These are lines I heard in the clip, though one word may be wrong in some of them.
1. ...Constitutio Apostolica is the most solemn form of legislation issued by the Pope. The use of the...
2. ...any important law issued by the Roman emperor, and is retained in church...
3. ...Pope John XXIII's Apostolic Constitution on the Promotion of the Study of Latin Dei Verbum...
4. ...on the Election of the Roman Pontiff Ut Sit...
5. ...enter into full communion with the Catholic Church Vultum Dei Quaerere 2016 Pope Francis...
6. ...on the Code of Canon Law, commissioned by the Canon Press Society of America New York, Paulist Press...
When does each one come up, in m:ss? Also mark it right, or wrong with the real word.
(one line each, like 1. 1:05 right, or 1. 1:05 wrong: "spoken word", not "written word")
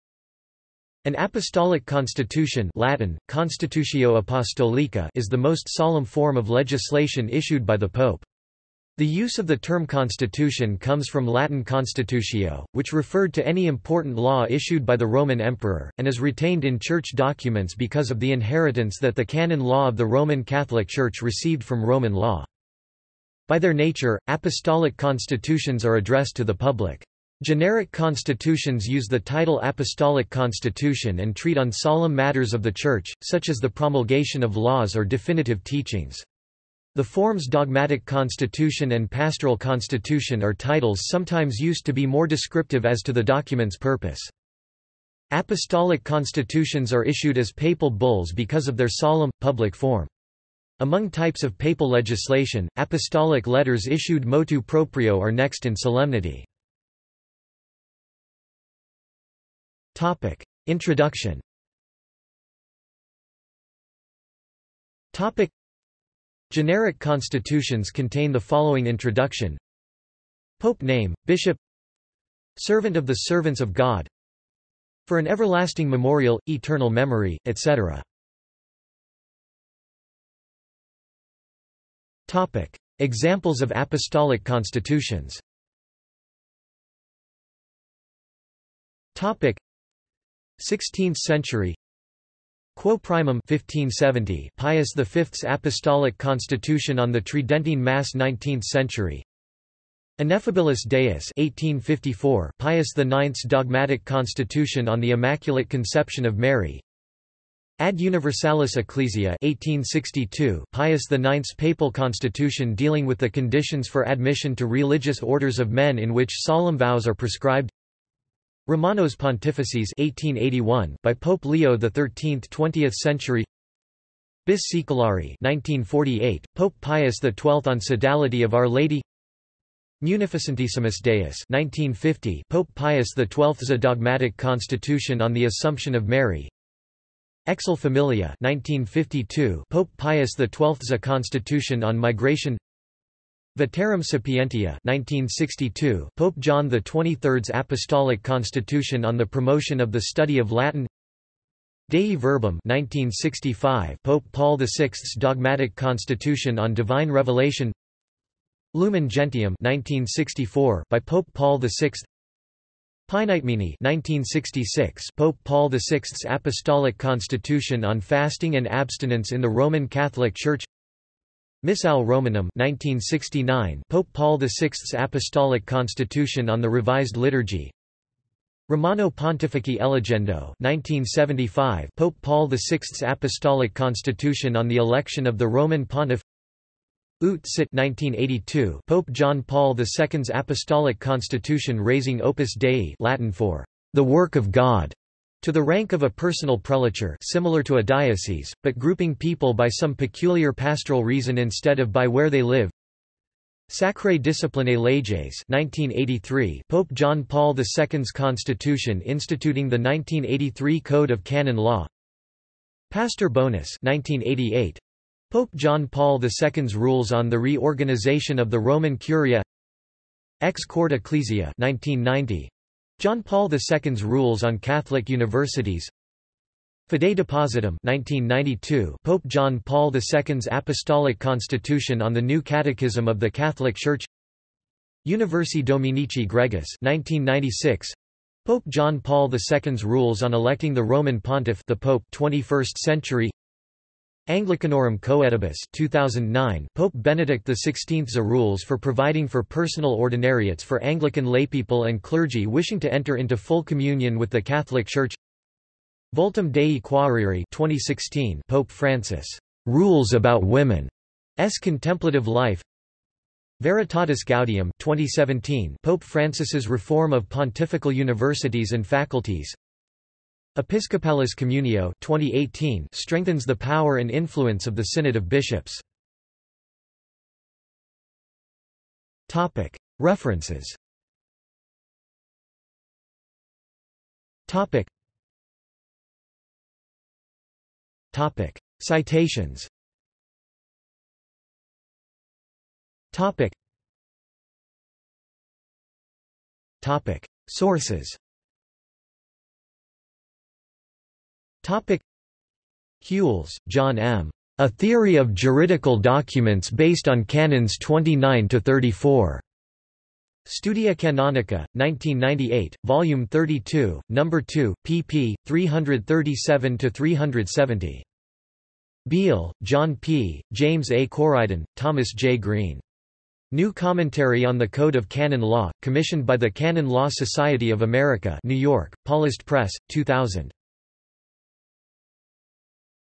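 1. 0:03 right
2. 0:13 right
3. 2:26 right
4. 3:04 right
5. 4:12 right
6. 5:24 wrong: "Law", not "Press".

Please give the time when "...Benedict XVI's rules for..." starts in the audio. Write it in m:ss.
4:06.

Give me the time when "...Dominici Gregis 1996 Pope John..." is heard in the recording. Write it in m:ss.
3:55.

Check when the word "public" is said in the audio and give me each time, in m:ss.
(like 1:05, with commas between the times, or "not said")
0:26, 0:49.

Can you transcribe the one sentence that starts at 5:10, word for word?
Studia Canonica, 1998, Volume 32, Number 2, pp.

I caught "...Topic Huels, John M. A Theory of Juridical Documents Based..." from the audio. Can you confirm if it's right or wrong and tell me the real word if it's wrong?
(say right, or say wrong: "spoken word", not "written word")
right.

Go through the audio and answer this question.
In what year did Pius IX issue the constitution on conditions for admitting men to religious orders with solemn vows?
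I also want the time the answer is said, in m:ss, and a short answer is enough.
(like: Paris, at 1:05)
1862, at 1:49.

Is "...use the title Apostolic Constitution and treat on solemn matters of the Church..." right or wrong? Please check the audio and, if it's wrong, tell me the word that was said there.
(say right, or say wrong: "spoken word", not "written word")
right.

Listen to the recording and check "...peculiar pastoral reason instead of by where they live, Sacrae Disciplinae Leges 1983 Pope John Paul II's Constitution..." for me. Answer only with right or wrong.
right.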